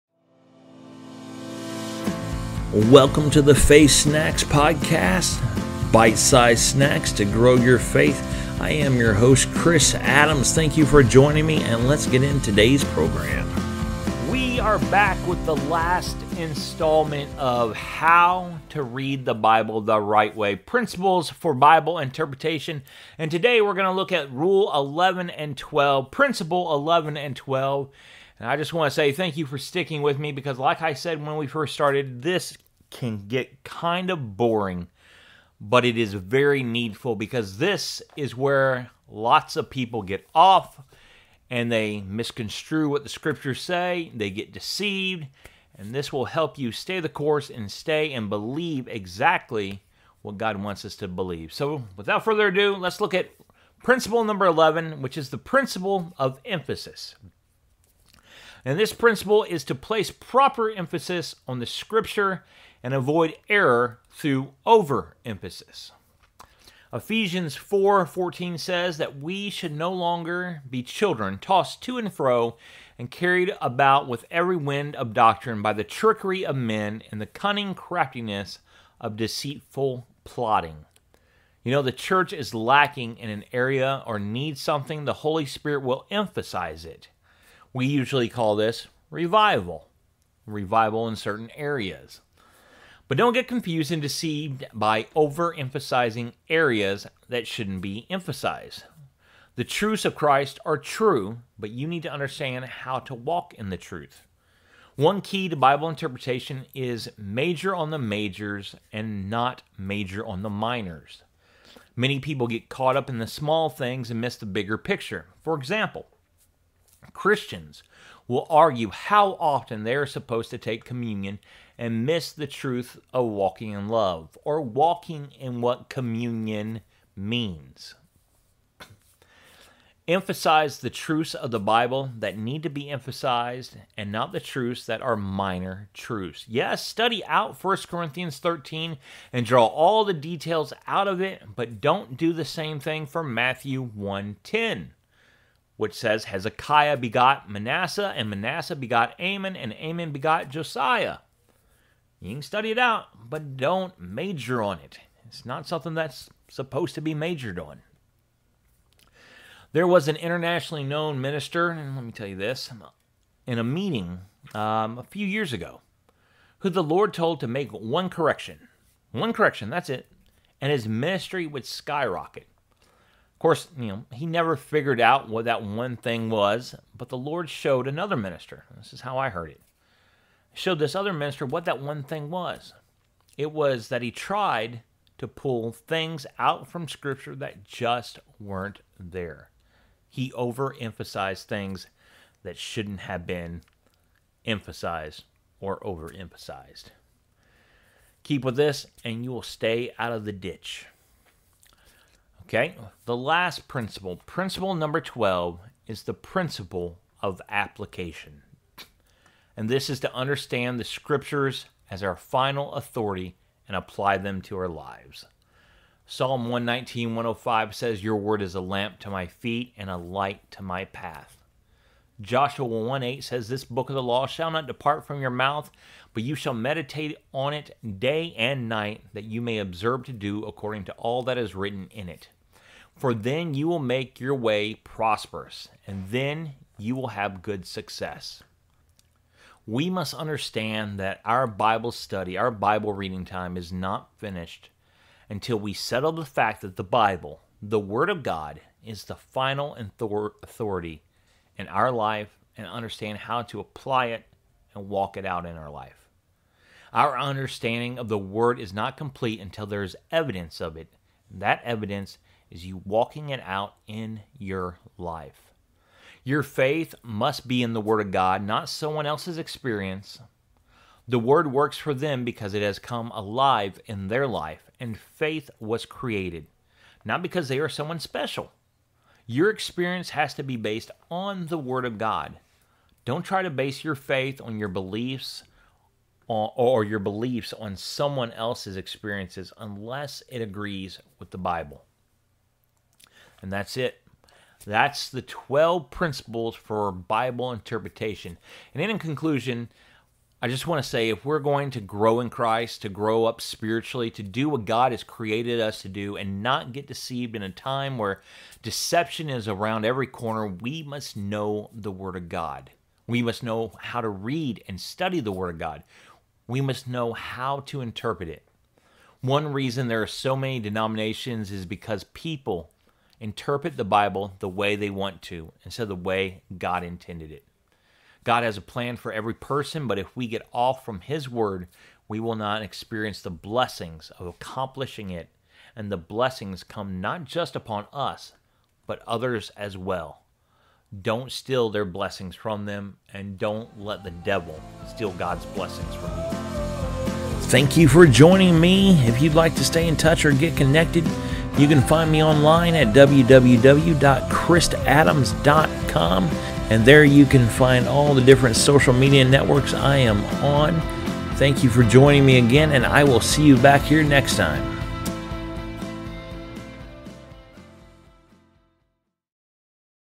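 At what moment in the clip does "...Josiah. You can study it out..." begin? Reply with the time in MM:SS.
02:30.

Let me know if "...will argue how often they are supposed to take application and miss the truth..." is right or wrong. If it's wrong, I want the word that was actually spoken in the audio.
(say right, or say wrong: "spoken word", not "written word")
wrong: "communion", not "application".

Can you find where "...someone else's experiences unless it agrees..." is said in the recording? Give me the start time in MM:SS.
04:47.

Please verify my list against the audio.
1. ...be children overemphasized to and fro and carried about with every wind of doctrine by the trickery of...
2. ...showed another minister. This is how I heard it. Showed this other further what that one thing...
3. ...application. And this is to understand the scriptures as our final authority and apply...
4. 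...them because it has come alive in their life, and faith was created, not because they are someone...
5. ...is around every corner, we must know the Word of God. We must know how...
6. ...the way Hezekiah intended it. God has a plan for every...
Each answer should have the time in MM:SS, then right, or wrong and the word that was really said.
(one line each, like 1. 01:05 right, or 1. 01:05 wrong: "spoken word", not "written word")
1. 01:10 wrong: "tossed", not "overemphasized"
2. 02:57 wrong: "minister", not "further"
3. 03:27 right
4. 04:31 right
5. 05:09 right
6. 05:25 wrong: "God", not "Hezekiah".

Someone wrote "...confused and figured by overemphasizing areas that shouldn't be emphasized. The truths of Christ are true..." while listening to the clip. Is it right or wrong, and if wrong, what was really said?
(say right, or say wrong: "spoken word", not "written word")
wrong: "deceived", not "figured".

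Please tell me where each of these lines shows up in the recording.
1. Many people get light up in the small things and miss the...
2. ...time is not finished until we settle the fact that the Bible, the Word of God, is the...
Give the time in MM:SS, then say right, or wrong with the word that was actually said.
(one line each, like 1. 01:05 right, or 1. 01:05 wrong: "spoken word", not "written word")
1. 01:51 wrong: "caught", not "light"
2. 04:03 right.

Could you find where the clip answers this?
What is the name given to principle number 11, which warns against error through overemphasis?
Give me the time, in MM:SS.
00:55.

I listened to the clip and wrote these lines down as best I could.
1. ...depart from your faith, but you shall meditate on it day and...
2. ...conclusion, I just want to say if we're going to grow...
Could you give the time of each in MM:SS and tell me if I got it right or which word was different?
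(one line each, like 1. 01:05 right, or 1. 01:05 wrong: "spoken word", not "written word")
1. 03:44 wrong: "mouth", not "faith"
2. 04:58 right.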